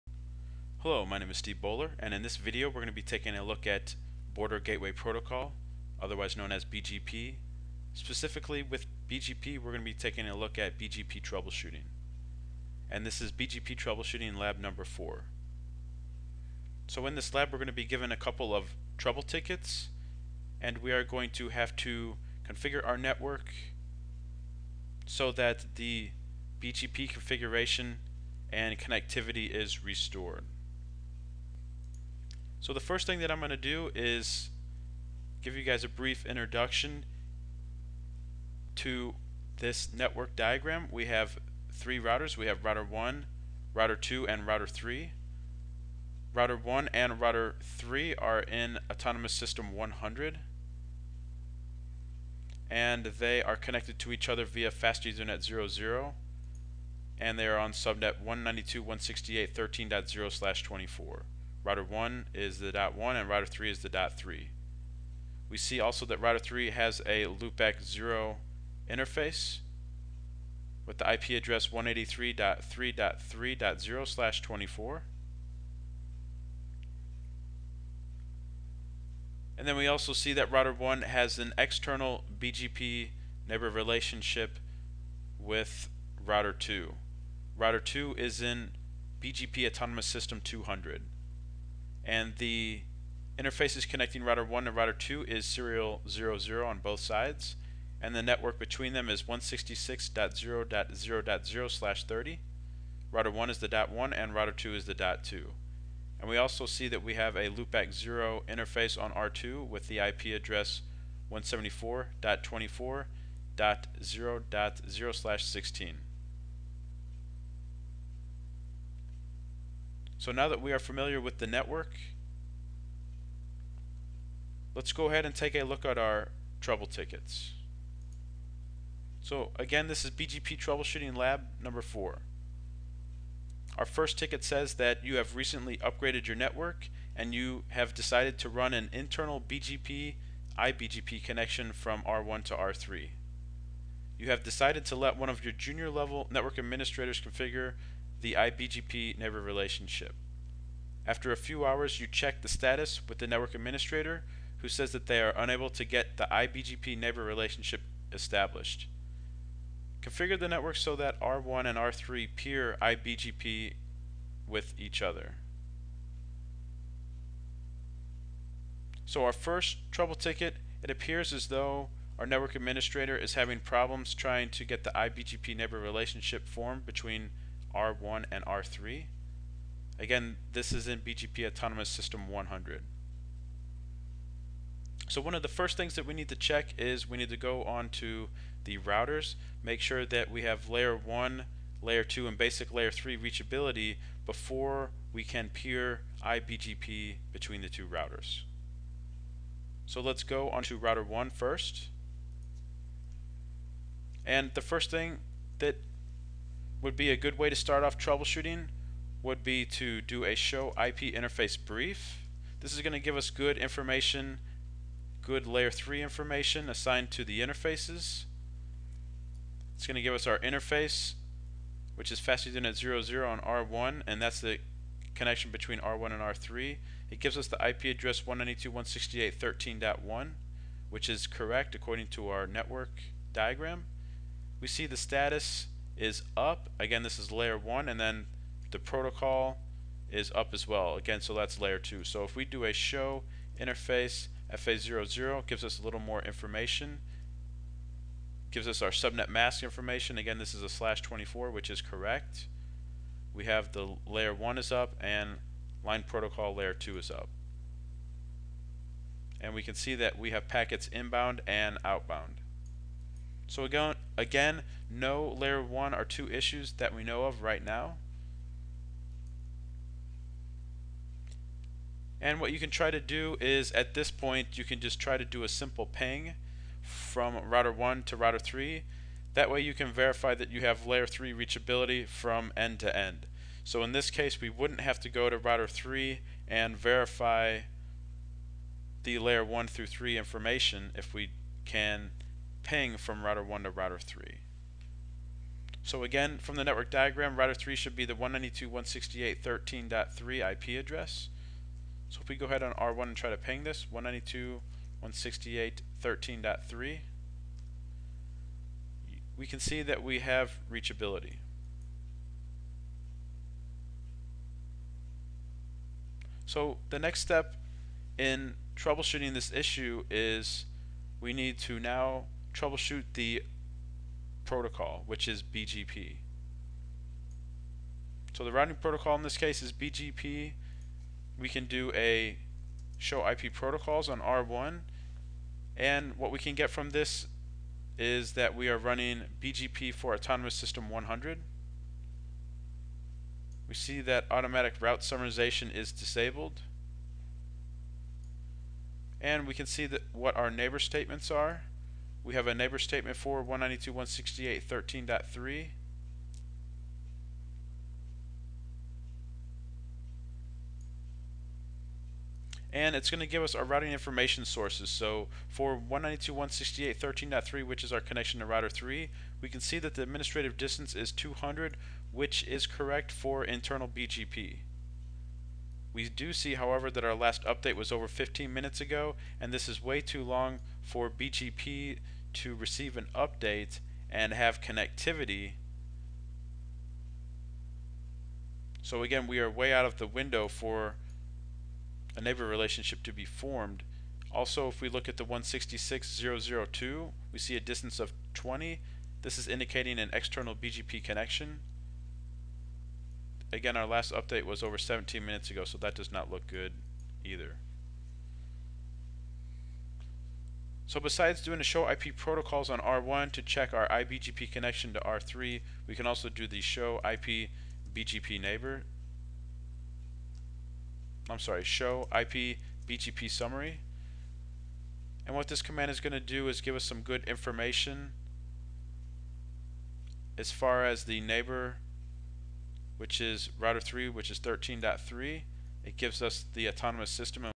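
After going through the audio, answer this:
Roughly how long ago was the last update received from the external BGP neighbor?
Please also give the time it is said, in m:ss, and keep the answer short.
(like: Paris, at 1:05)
over 17 minutes, at 6:44.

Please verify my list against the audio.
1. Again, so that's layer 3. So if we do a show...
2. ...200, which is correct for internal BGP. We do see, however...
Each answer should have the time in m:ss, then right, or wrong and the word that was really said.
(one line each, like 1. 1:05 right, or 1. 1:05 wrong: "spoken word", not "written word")
1. 4:00 wrong: "2", not "3"
2. 6:11 right.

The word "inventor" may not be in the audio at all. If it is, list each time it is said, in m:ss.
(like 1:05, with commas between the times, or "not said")
not said.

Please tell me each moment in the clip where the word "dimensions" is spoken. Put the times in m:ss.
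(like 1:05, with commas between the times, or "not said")
not said.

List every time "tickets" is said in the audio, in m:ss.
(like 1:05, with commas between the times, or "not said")
0:19, 2:06, 2:14, 2:50.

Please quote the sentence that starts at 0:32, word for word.
So the first thing that I'm going to do is give you guys a brief introduction to this network diagram.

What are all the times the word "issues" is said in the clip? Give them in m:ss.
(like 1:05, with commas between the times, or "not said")
4:26, 5:19.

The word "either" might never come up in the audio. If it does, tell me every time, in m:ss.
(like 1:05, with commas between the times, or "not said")
6:47.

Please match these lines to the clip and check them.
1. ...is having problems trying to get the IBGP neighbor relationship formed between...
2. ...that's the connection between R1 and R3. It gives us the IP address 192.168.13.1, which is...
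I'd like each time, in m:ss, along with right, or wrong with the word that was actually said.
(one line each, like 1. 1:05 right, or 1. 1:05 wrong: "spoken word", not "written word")
1. 2:53 right
2. 3:44 right.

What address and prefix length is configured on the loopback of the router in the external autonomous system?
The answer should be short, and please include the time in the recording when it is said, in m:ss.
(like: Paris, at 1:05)
174.24.0.0/16, at 1:51.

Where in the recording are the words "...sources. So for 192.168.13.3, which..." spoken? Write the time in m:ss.
6:04.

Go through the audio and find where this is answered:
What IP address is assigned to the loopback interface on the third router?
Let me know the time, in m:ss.
1:11.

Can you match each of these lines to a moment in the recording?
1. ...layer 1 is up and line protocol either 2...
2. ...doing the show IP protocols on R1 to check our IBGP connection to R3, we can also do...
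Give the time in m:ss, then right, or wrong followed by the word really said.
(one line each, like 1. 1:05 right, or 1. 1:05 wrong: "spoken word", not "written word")
1. 4:14 wrong: "layer", not "either"
2. 6:51 right.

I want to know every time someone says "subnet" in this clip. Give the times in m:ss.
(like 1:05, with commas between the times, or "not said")
0:57, 4:08.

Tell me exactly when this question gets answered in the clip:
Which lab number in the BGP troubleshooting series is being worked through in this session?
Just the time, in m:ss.
0:14.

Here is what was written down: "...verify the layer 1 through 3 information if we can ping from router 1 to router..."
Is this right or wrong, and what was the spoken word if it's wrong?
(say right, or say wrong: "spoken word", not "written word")
right.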